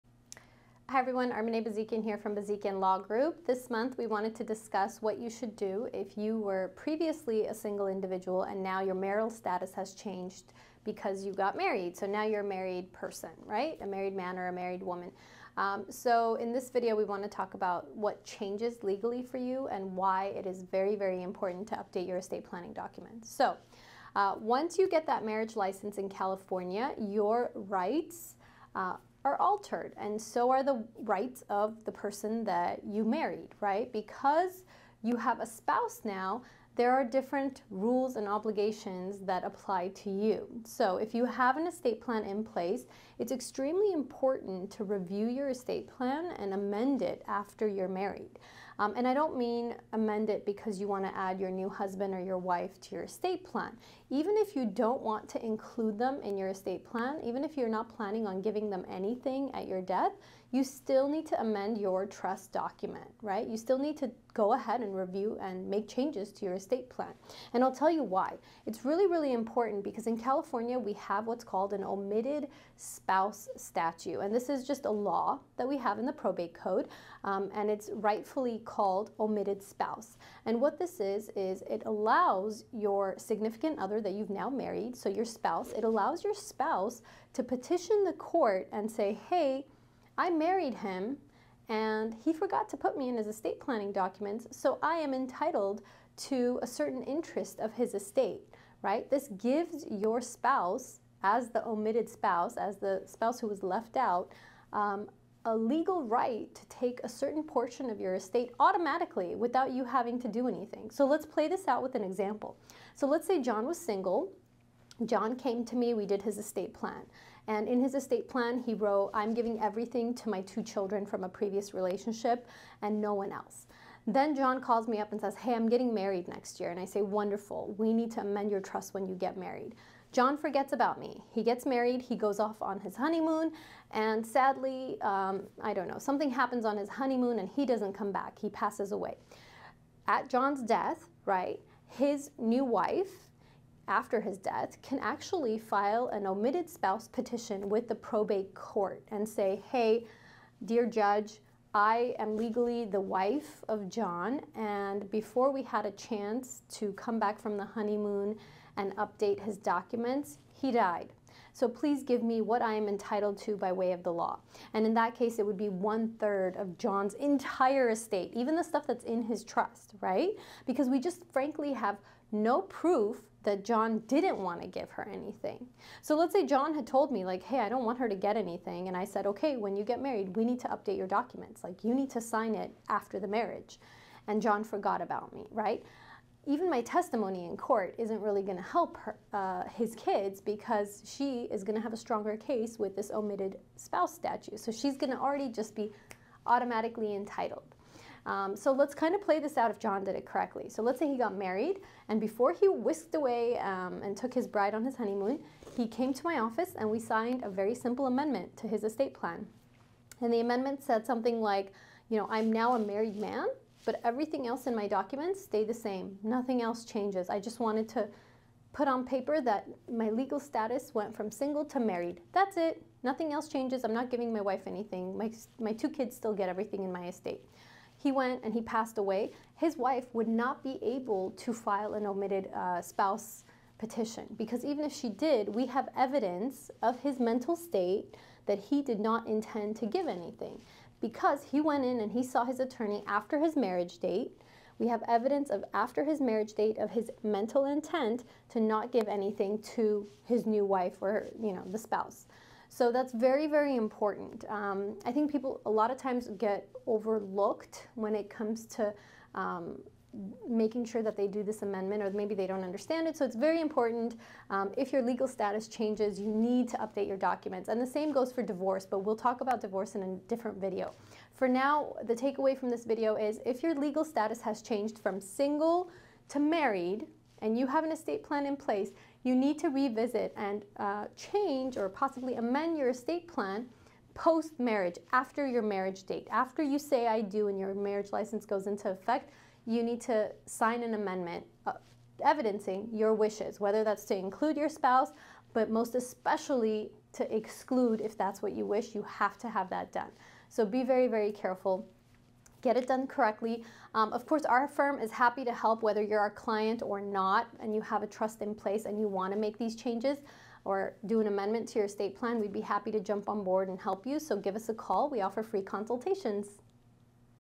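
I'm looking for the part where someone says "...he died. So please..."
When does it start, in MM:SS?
02:40.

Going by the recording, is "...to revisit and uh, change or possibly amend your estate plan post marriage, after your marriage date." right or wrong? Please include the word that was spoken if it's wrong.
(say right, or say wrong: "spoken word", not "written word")
right.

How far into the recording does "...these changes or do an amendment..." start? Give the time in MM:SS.
05:09.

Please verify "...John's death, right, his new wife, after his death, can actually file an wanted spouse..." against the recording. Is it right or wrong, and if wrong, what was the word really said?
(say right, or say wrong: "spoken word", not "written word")
wrong: "omitted", not "wanted".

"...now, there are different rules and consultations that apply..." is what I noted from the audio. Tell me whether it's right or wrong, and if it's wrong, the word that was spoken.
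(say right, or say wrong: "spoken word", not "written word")
wrong: "obligations", not "consultations".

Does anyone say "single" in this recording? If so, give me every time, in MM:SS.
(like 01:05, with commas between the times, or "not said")
00:07, 01:53, 03:41, 04:35.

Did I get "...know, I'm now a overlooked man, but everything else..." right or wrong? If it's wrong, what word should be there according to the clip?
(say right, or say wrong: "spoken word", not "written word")
wrong: "married", not "overlooked".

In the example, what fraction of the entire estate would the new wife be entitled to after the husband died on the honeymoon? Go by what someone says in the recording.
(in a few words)
one third.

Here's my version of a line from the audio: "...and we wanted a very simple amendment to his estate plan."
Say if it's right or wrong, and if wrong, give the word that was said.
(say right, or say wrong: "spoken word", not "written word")
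wrong: "signed", not "wanted".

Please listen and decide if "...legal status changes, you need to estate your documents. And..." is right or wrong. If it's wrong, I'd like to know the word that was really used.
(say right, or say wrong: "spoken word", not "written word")
wrong: "update", not "estate".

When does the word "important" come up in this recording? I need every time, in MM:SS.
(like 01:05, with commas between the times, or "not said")
00:21, 00:43, 01:09, 04:13, 04:23.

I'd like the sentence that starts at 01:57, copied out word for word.
And in his estate plan, he wrote, I'm giving everything to my two children from a previous relationship and no one else.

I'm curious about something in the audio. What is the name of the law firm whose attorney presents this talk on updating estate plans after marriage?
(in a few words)
Bazikyan Law Group.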